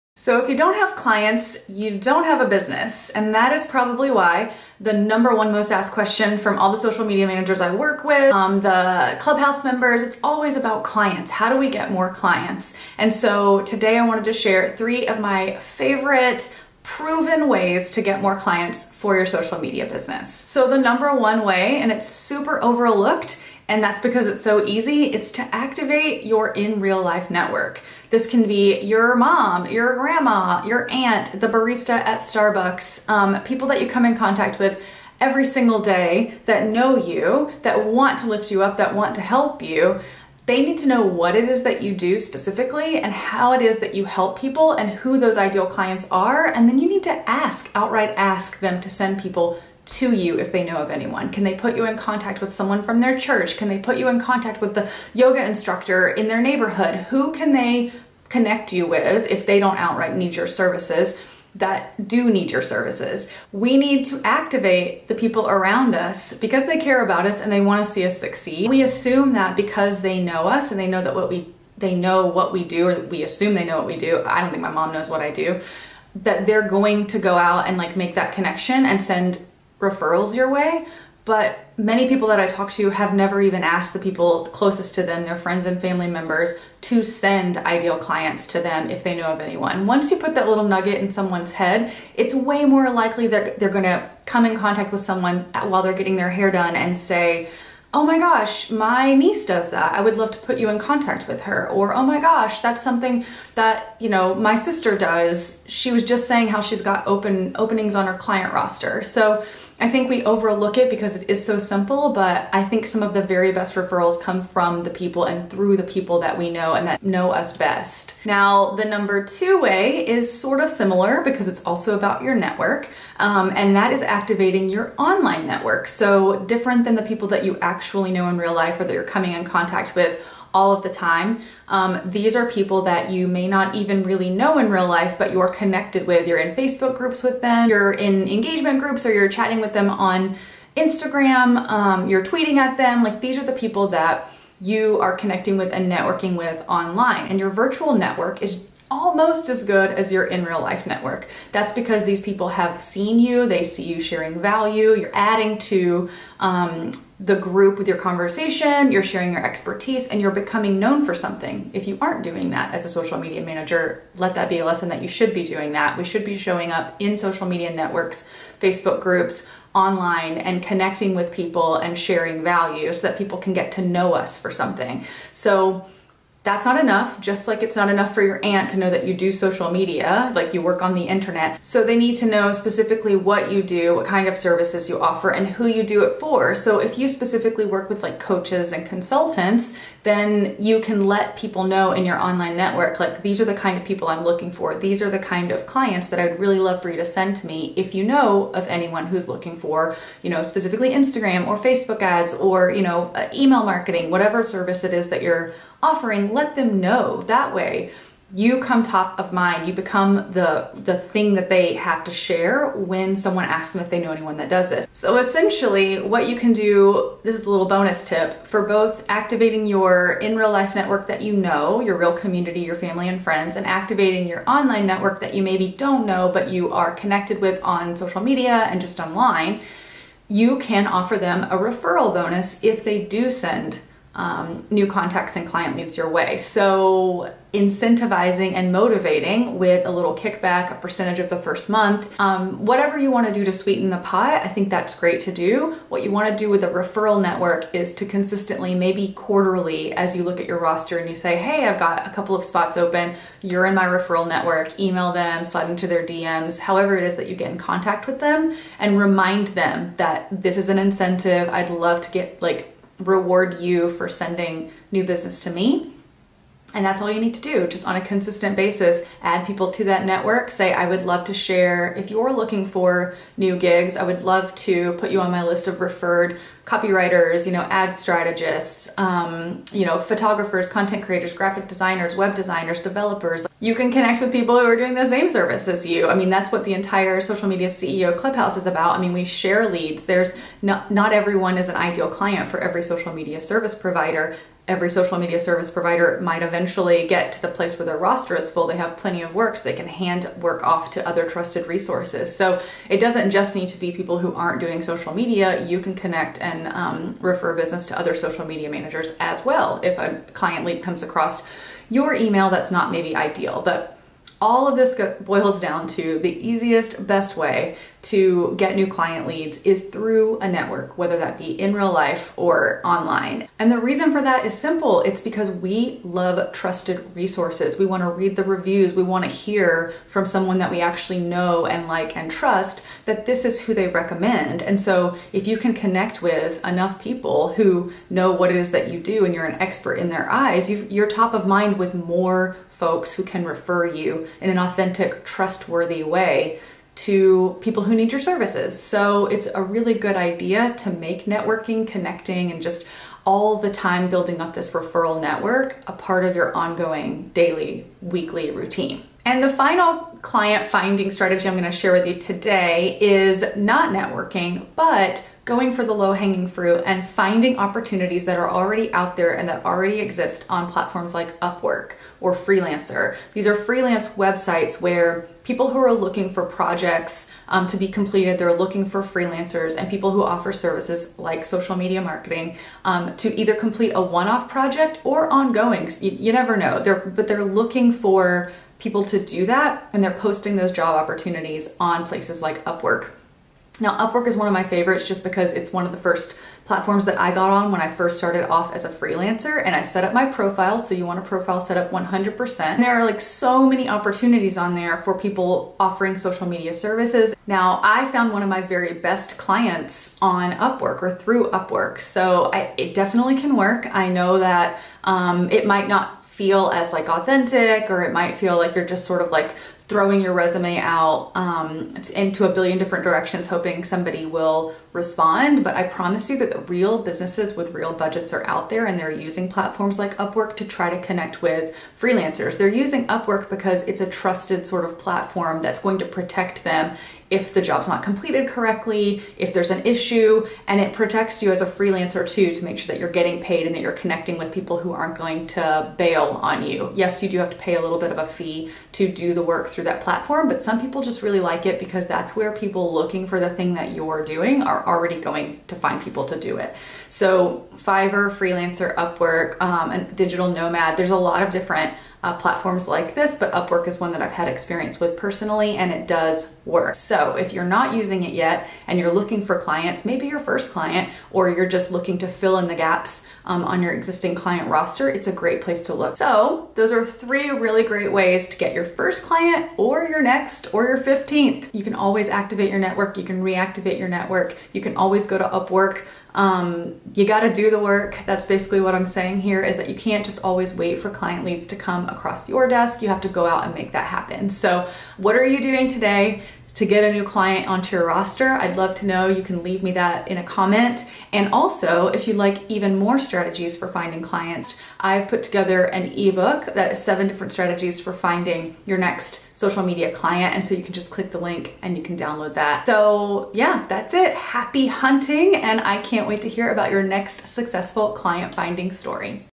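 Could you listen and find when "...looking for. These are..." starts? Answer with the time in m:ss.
3:14.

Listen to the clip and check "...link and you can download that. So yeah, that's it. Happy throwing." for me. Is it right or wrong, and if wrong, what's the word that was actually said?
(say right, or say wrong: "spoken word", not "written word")
wrong: "hunting", not "throwing".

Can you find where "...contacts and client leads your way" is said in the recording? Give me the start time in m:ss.
3:54.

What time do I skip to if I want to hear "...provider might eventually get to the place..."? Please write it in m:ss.
4:55.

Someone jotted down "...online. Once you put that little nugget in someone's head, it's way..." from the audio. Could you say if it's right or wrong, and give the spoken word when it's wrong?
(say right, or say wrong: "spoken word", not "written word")
wrong: "anyone", not "online".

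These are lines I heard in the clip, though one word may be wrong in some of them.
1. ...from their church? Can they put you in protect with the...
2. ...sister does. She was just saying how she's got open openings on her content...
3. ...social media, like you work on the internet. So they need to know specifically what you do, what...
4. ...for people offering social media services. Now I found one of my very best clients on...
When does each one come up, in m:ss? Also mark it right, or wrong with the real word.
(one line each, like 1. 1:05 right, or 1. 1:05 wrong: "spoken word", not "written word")
1. 0:52 wrong: "contact", not "protect"
2. 1:44 wrong: "client", not "content"
3. 2:59 right
4. 6:45 right.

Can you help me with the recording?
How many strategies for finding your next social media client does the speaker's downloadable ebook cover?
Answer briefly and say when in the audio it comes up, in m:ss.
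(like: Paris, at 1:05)
7, at 8:27.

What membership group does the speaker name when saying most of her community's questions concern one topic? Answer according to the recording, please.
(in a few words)
the clubhouse.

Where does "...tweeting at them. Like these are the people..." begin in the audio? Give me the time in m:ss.
2:22.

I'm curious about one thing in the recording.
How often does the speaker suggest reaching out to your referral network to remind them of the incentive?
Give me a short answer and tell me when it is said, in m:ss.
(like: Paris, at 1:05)
quarterly, at 4:09.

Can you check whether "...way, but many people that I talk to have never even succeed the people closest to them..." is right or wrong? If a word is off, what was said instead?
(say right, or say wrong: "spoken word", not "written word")
wrong: "asked", not "succeed".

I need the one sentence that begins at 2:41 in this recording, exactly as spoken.
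If you aren't doing that as a social media manager, let that be a lesson that you should be doing that.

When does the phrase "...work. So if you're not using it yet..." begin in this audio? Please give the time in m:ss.
7:46.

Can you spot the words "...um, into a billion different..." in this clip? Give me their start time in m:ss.
7:01.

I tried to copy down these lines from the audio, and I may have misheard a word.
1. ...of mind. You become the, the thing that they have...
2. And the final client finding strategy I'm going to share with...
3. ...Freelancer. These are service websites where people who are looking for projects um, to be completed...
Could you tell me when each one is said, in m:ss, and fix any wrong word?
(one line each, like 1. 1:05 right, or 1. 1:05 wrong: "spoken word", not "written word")
1. 3:29 right
2. 5:59 right
3. 6:12 wrong: "freelance", not "service".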